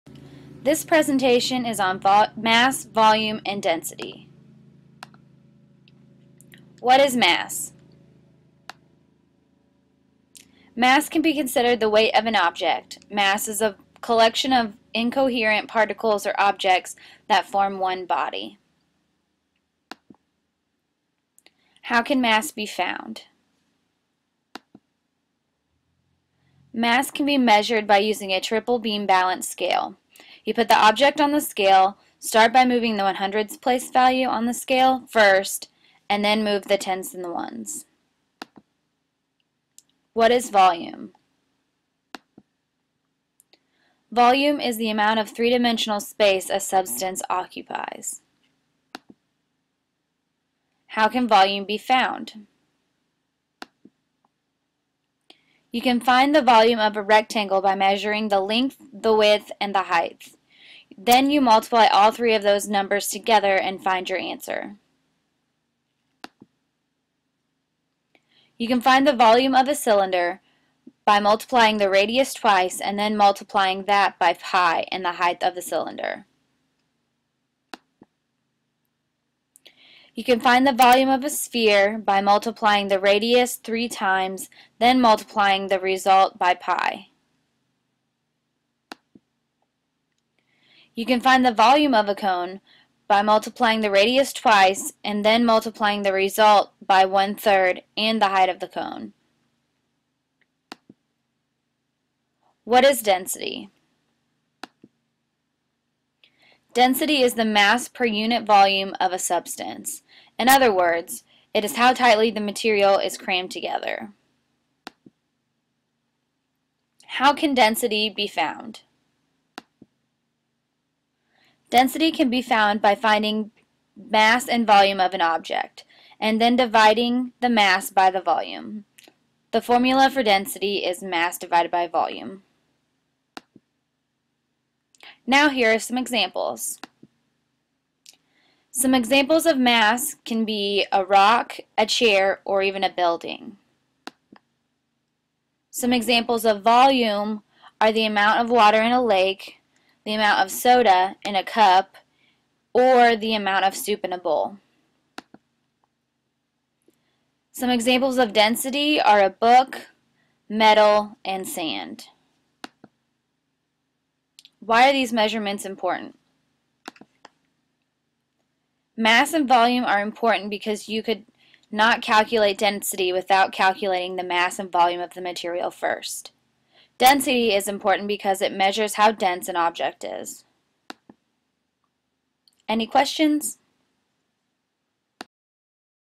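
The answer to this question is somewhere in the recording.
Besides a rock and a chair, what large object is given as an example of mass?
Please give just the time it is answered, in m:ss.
2:22.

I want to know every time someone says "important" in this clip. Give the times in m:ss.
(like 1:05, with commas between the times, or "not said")
2:45, 2:50, 2:57.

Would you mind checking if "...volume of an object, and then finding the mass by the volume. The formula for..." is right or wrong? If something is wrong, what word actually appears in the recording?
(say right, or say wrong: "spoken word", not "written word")
wrong: "dividing", not "finding".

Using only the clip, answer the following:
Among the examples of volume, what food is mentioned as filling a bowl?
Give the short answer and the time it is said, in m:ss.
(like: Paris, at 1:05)
Soup, at 2:33.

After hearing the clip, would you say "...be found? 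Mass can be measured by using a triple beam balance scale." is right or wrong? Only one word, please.
right.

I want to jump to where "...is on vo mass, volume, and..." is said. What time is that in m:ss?
0:01.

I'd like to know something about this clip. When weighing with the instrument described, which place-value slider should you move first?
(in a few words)
The 100s.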